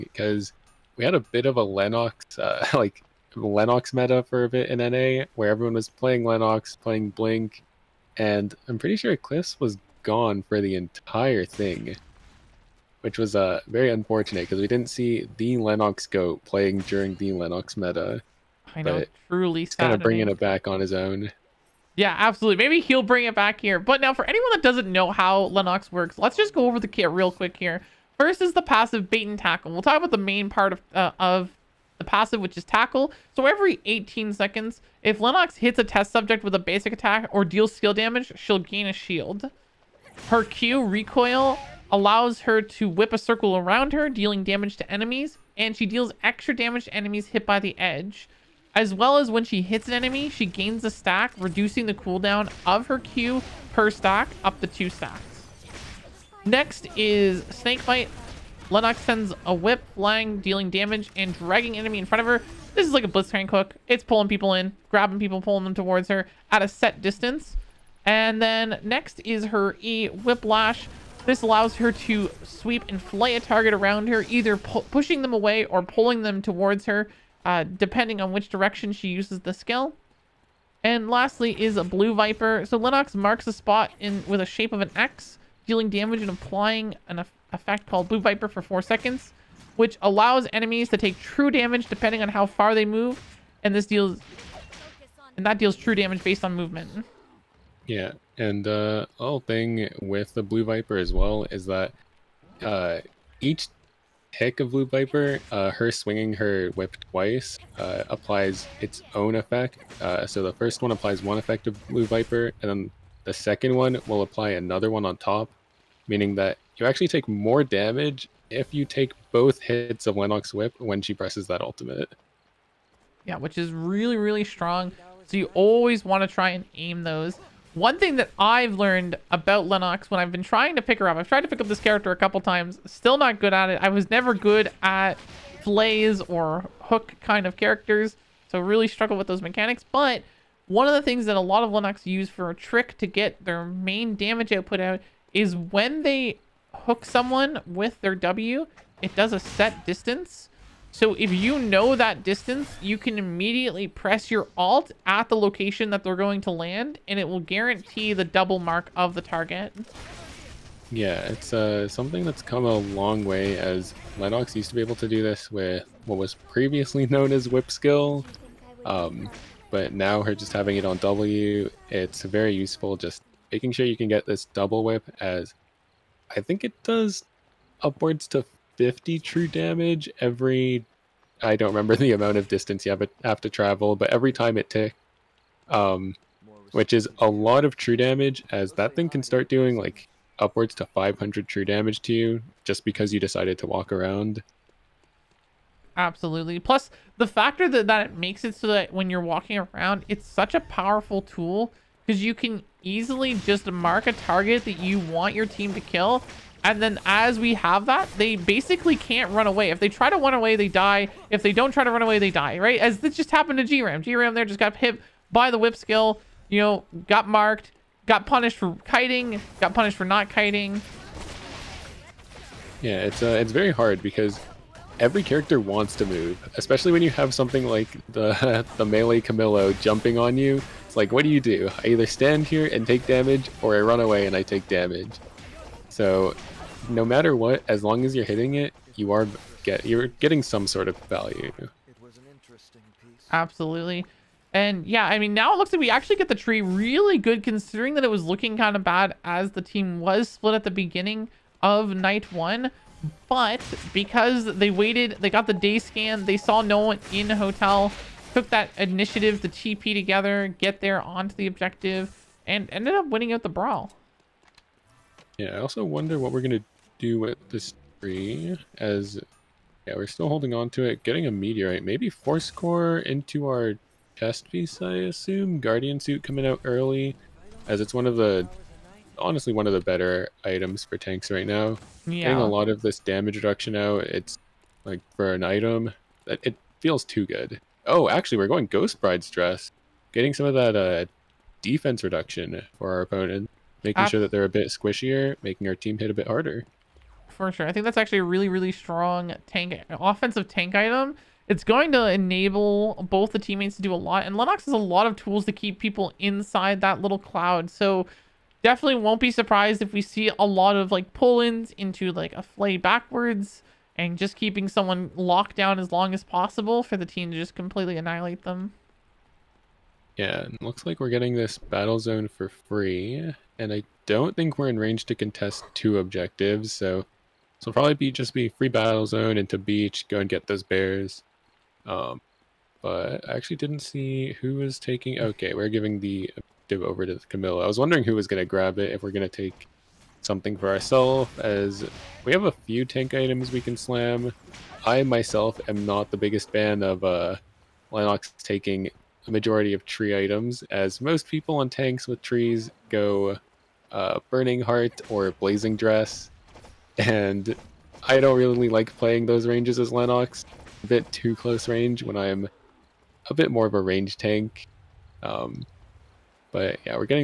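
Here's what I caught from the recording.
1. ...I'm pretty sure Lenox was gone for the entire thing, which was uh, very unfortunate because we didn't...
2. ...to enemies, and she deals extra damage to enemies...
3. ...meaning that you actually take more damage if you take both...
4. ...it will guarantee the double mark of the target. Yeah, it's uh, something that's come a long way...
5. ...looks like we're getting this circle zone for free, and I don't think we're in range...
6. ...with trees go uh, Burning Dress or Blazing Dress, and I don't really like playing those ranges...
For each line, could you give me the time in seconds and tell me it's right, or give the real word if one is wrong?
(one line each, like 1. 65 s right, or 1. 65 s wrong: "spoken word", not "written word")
1. 8 s wrong: "Eclipse", not "Lenox"
2. 44 s right
3. 116 s right
4. 157 s right
5. 320 s wrong: "battle", not "circle"
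6. 352 s wrong: "Heart", not "Dress".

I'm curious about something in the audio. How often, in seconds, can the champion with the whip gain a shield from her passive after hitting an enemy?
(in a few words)
18.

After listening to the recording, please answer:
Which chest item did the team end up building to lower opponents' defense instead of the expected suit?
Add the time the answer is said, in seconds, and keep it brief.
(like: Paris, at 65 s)
Ghost Bride's dress, at 288 s.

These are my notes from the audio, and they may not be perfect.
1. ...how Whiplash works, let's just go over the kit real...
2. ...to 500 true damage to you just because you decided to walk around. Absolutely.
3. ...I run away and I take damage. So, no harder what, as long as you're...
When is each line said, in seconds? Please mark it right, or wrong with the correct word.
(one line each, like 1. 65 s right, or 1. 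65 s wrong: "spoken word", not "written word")
1. 25 s wrong: "Lenox", not "Whiplash"
2. 190 s right
3. 233 s wrong: "matter", not "harder".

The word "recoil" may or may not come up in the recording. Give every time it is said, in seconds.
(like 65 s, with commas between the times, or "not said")
40 s.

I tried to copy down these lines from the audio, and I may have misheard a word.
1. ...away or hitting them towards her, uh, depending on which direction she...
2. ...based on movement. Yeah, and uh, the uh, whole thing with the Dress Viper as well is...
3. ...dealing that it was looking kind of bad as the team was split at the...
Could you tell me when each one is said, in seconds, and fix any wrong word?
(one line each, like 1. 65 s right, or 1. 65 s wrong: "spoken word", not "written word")
1. 75 s wrong: "pulling", not "hitting"
2. 96 s wrong: "Blue", not "Dress"
3. 247 s wrong: "considering", not "dealing".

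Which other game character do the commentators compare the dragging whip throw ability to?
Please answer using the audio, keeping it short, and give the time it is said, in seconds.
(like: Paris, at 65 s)
Blitzcrank, at 63 s.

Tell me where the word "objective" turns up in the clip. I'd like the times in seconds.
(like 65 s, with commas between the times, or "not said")
261 s, 325 s.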